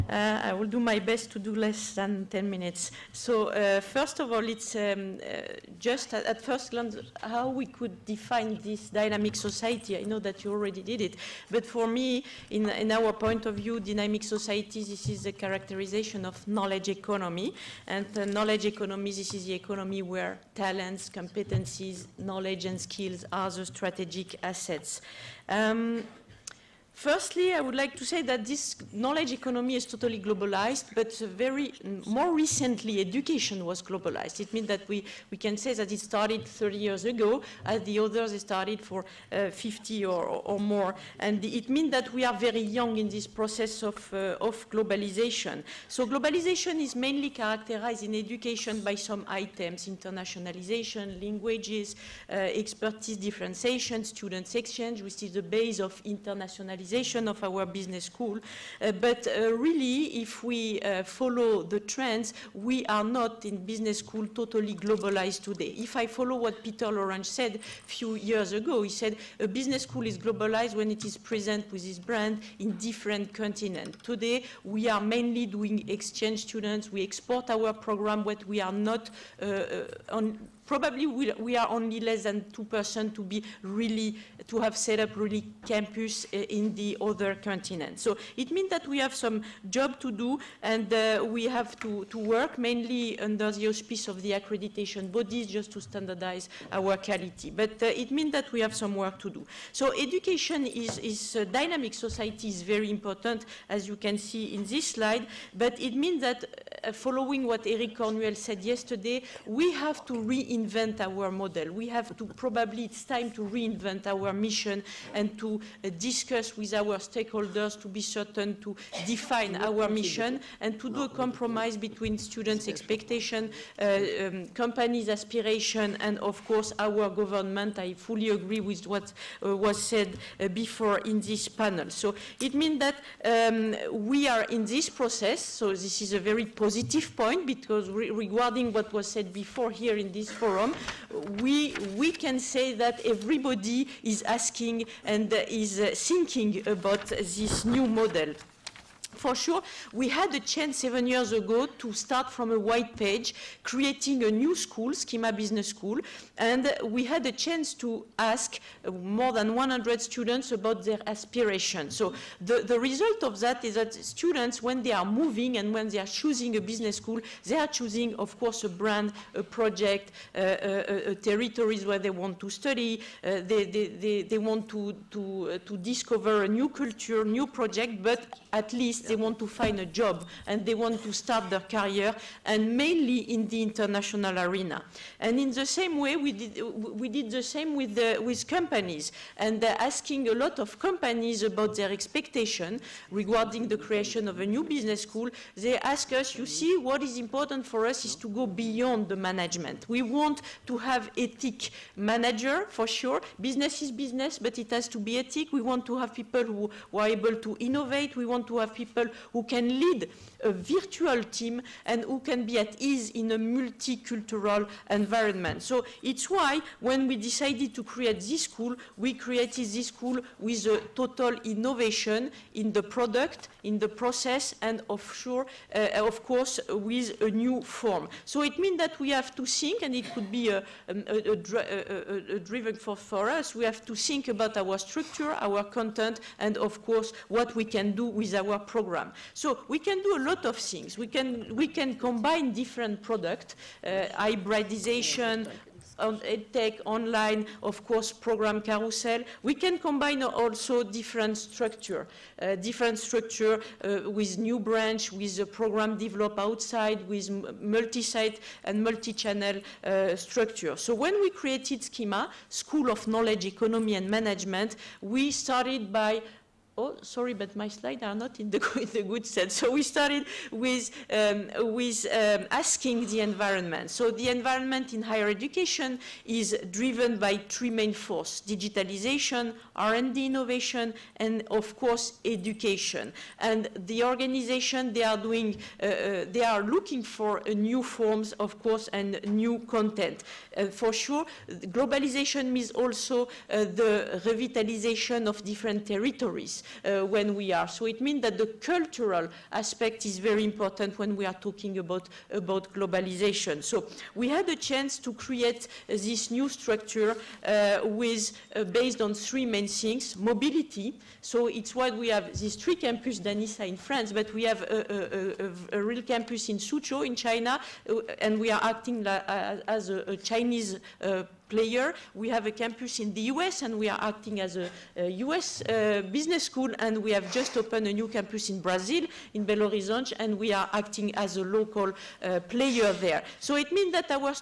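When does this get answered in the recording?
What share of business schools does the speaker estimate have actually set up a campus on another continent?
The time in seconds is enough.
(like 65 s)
81 s.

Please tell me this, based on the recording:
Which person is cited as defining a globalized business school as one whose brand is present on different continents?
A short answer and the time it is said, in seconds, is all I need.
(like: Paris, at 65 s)
Peter Lorange, at 66 s.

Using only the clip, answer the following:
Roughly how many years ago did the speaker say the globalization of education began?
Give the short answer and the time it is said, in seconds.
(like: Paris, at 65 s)
30 years, at 36 s.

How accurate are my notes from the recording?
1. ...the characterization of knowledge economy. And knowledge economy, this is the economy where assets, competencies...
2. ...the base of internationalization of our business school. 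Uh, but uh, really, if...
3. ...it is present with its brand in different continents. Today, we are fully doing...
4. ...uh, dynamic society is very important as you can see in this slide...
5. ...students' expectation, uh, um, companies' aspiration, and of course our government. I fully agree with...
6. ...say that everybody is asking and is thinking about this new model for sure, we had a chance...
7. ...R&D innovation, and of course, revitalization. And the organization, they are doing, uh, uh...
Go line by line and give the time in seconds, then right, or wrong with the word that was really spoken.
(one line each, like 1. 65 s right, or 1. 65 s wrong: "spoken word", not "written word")
1. 15 s wrong: "talents", not "assets"
2. 55 s right
3. 70 s wrong: "mainly", not "fully"
4. 101 s right
5. 122 s right
6. 142 s right
7. 279 s wrong: "education", not "revitalization".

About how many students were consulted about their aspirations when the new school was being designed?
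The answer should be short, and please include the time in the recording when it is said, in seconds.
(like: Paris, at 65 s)
more than 100, at 158 s.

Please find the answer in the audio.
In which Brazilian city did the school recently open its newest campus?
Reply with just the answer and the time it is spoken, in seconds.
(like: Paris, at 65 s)
Belo Horizonte, at 329 s.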